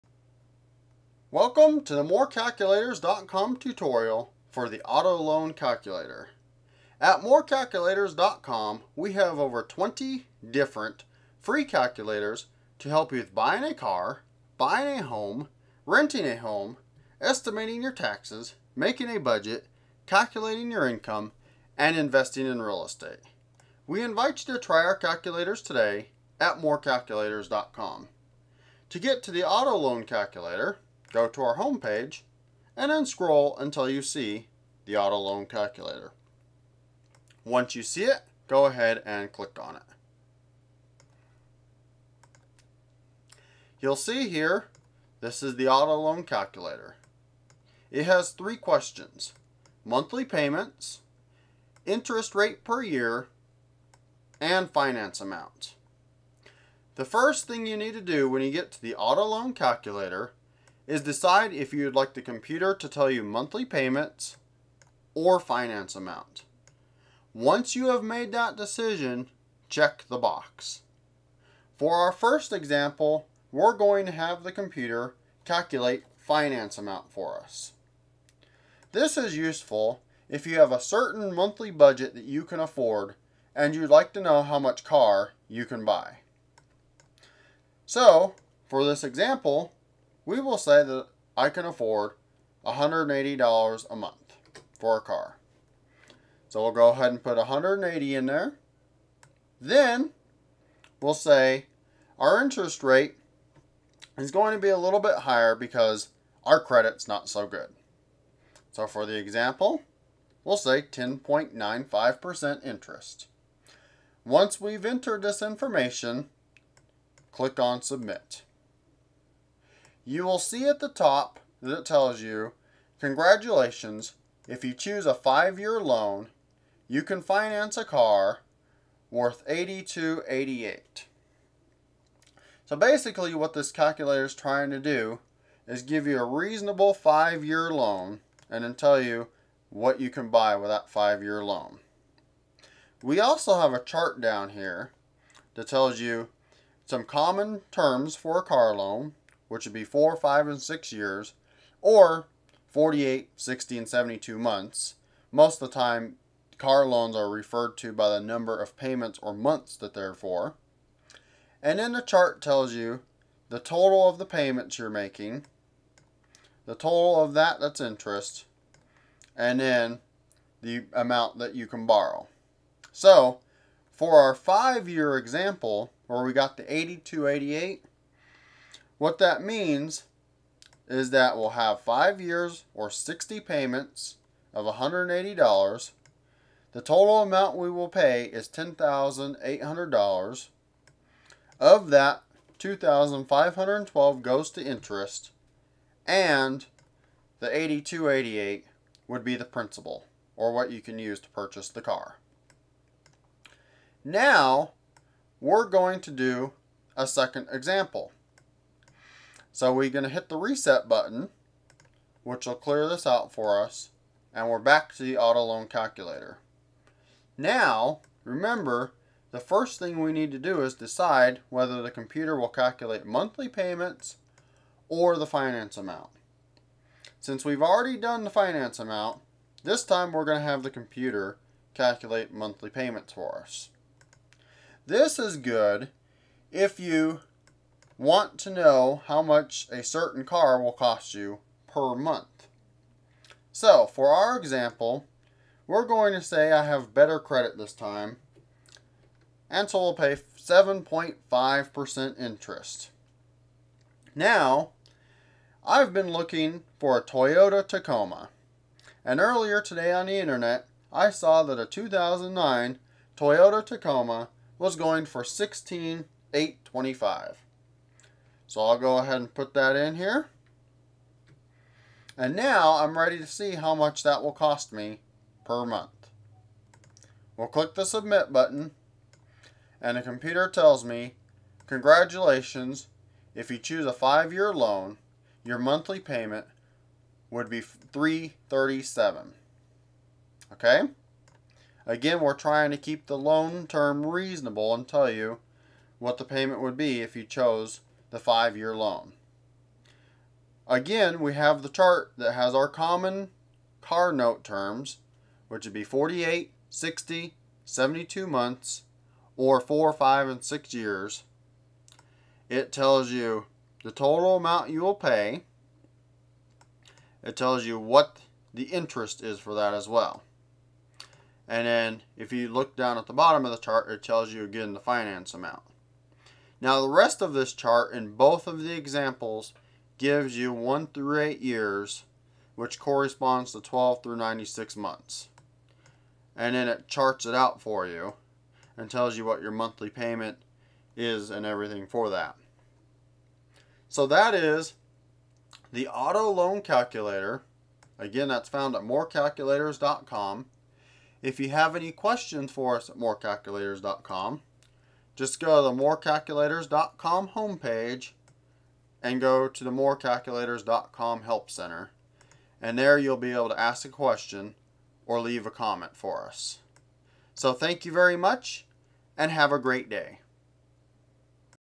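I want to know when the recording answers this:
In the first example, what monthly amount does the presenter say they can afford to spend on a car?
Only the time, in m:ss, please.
1:32.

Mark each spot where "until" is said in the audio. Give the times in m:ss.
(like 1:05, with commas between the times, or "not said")
0:33.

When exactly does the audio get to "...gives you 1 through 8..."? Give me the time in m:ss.
5:29.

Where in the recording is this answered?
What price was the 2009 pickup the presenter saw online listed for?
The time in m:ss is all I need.
4:25.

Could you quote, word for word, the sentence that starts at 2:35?
Most of the time, car loans are referred to by the number of payments or months that they're for.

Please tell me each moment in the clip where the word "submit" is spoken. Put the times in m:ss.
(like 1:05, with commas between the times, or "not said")
1:57, 4:37.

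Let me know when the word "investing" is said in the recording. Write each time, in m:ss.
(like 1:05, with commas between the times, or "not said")
0:21.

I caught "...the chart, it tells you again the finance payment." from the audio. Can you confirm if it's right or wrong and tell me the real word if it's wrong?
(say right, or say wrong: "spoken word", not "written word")
wrong: "amount", not "payment".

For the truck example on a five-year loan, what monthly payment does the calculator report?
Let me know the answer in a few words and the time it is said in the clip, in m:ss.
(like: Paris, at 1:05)
$337, at 4:47.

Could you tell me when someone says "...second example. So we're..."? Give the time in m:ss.
3:27.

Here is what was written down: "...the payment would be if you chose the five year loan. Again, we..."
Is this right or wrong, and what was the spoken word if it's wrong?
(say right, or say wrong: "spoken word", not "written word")
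right.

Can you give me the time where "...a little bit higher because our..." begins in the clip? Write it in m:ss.
1:44.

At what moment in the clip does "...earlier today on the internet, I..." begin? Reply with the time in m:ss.
4:19.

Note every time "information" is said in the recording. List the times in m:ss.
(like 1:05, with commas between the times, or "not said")
1:55.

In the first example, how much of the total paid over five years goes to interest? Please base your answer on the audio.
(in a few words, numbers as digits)
$2,512.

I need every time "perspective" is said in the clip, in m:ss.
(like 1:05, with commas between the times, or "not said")
not said.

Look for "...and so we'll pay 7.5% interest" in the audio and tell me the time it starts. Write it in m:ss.
4:09.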